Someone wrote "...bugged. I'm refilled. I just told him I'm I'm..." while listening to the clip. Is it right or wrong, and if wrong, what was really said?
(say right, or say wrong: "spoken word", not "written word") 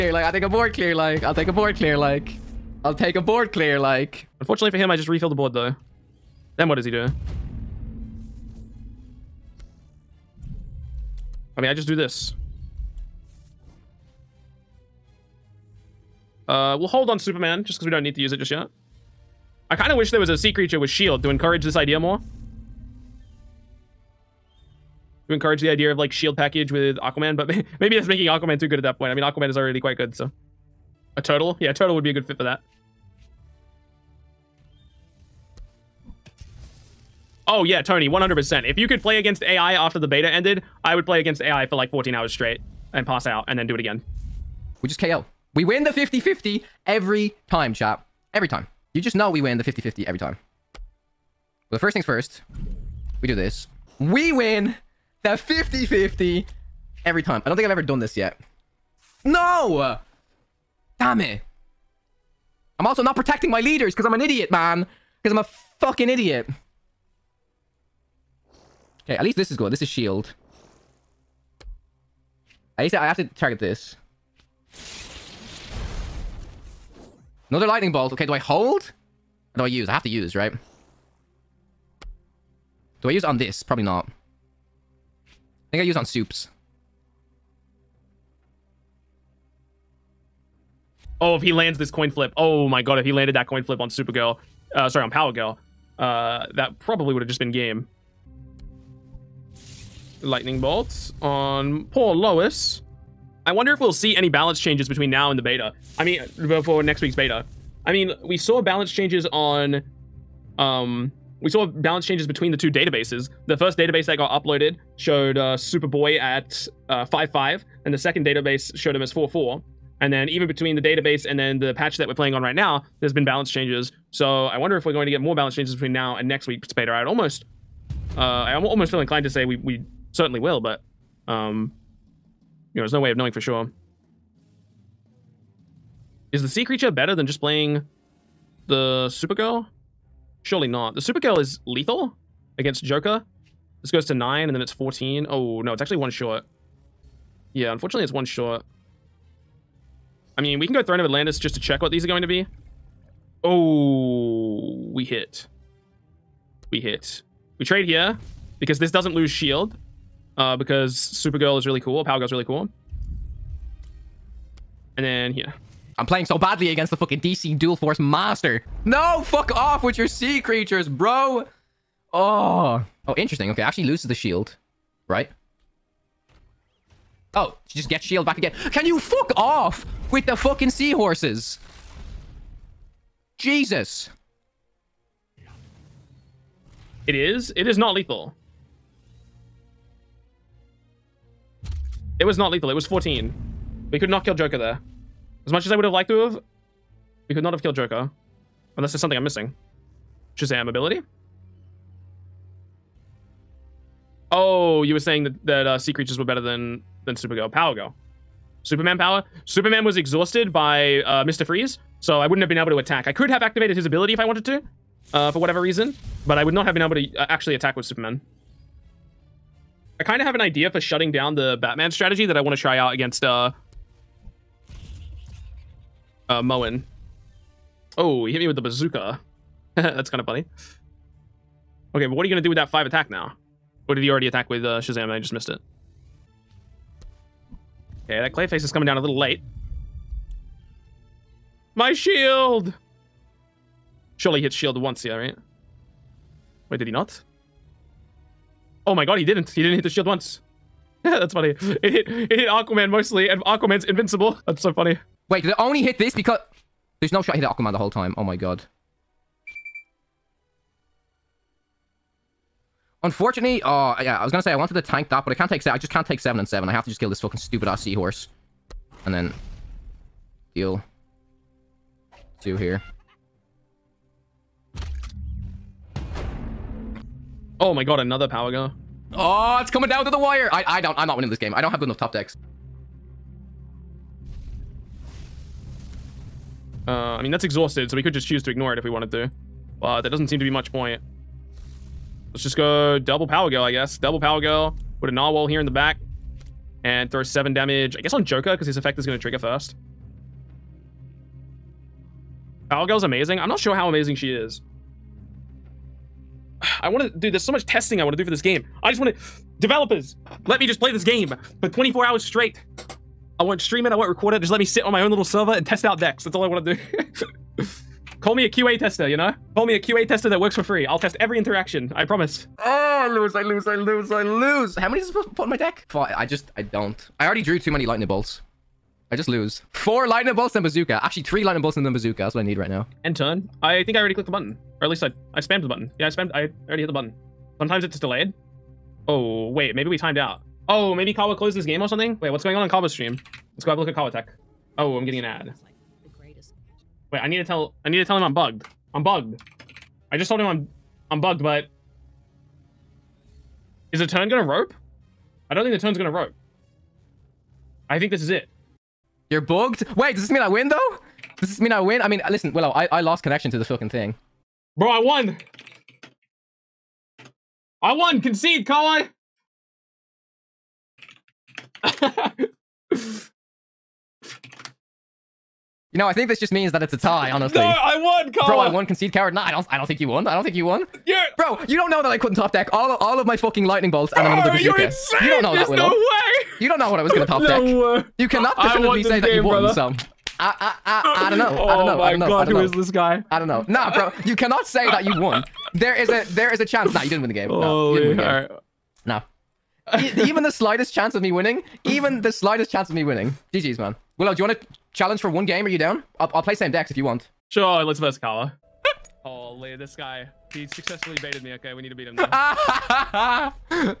wrong: "bugged", not "refilled".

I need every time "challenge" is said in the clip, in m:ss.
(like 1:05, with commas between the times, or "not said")
6:44.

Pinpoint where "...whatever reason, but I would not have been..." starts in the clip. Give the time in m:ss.
3:35.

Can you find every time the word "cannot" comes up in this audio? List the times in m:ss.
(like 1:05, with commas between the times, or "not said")
6:28, 6:34.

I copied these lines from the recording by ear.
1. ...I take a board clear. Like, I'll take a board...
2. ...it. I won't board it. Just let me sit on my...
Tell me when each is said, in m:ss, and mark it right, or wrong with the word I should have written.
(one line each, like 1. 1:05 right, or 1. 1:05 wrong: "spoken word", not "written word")
1. 0:00 right
2. 5:13 wrong: "record", not "board".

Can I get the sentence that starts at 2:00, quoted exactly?
And then even between the database and then the patch that we're playing on right now, there's been balance changes.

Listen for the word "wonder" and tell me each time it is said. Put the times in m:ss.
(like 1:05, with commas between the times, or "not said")
1:43, 2:04.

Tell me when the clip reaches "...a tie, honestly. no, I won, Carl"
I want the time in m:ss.
6:16.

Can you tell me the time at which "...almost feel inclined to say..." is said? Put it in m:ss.
2:08.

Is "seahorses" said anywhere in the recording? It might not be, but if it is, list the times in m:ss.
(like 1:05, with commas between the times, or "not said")
3:00, 4:27.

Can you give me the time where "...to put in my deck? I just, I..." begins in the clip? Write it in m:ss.
5:25.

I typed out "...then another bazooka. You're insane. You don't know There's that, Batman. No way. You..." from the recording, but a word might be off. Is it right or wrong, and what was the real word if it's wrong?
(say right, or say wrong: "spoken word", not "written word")
wrong: "Willow", not "Batman".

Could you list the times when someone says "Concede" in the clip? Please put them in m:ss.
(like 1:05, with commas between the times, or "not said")
6:08, 6:18.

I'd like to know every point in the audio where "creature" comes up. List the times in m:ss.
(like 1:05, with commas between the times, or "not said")
0:20, 2:16, 2:50, 3:25.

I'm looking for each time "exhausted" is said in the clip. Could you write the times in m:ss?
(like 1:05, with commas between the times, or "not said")
3:29, 4:47.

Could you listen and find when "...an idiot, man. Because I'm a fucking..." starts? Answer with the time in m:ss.
1:04.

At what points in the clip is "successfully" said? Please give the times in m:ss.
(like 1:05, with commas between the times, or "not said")
6:50.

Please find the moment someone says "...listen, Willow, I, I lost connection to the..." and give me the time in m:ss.
6:02.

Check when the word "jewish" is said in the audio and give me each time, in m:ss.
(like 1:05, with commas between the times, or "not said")
not said.